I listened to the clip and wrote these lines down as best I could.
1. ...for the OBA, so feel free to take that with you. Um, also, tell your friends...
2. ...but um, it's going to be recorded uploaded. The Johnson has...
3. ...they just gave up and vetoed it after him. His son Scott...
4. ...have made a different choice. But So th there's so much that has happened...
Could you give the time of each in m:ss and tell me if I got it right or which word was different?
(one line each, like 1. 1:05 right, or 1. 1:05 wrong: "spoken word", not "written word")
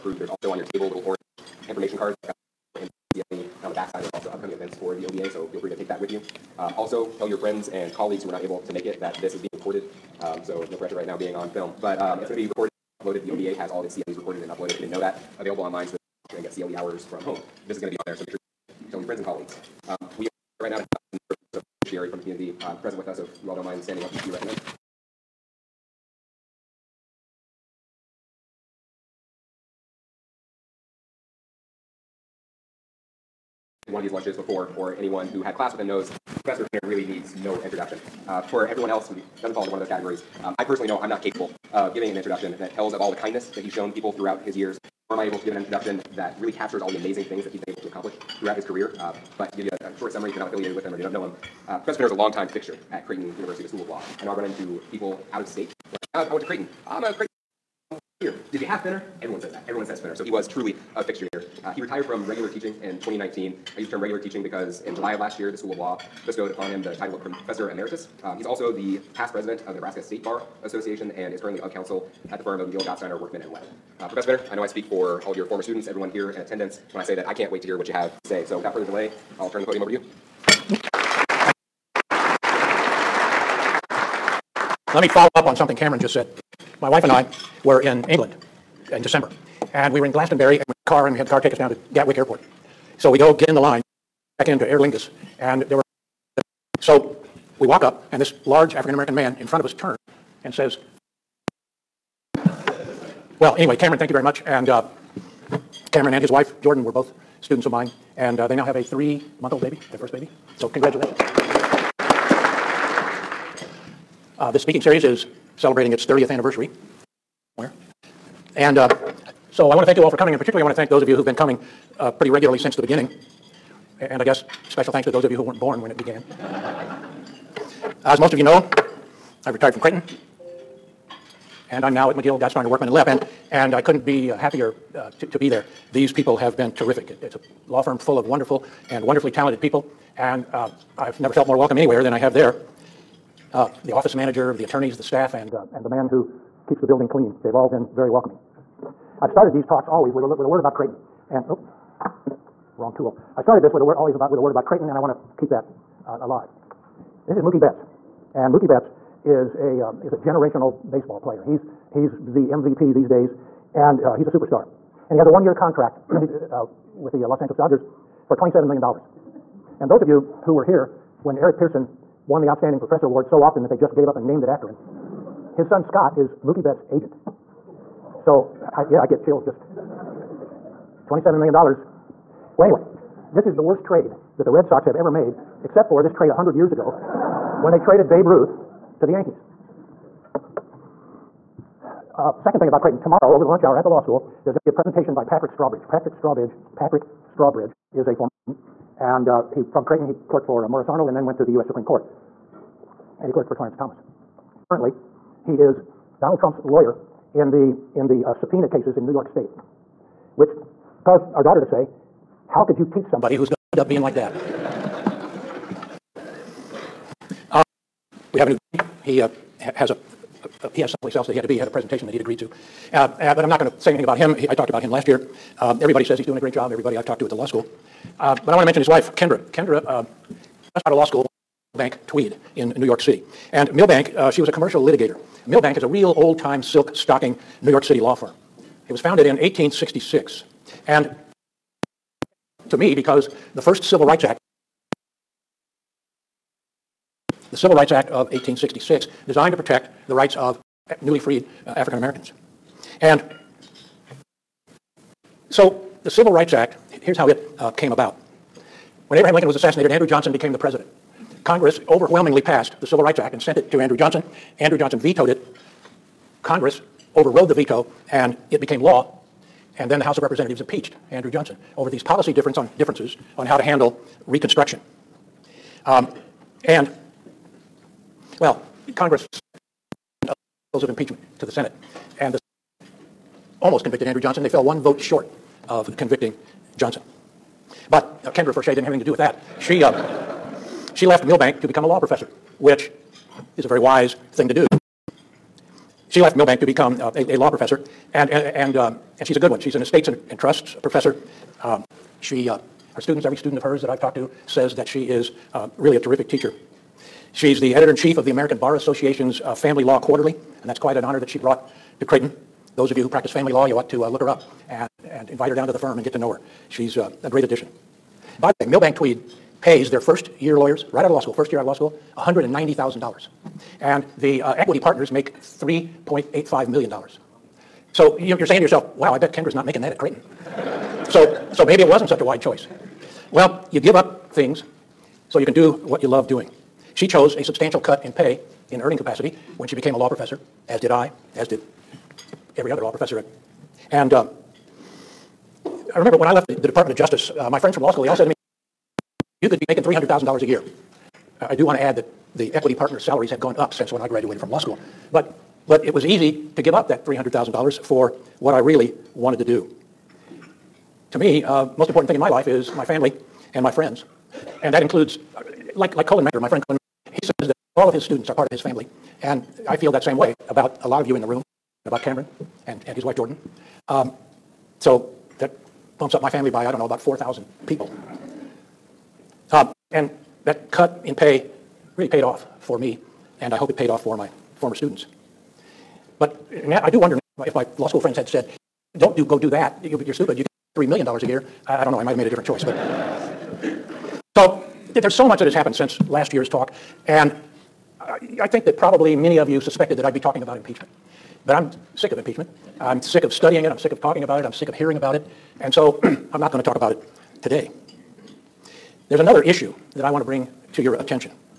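1. 0:04 right
2. 0:11 wrong: "OBA", not "Johnson"
3. 2:53 wrong: "named", not "vetoed"
4. 6:32 right.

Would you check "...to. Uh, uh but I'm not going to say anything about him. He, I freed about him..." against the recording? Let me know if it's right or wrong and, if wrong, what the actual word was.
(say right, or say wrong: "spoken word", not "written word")
wrong: "talked", not "freed".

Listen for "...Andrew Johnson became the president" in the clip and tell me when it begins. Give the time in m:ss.
4:19.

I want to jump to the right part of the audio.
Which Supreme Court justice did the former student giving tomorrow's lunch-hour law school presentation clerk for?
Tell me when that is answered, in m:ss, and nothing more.
3:23.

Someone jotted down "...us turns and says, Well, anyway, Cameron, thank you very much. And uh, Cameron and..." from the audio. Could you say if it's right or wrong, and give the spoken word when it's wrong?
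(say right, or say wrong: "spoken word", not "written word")
right.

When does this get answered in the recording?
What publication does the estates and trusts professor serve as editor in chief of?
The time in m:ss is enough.
5:09.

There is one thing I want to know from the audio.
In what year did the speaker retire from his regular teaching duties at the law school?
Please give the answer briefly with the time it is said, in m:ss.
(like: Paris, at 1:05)
2019, at 1:03.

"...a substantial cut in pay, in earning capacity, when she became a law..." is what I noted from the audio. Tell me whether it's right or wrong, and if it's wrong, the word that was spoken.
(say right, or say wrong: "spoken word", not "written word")
right.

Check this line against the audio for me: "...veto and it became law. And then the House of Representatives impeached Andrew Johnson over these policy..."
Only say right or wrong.
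right.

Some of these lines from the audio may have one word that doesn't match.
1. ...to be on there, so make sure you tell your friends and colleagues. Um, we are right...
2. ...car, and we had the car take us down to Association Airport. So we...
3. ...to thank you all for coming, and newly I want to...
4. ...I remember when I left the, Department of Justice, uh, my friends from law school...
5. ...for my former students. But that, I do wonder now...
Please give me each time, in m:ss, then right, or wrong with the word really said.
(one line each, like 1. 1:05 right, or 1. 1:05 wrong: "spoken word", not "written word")
1. 0:17 right
2. 1:30 wrong: "Gatwick", not "Association"
3. 1:59 wrong: "particularly", not "newly"
4. 5:45 right
5. 6:24 right.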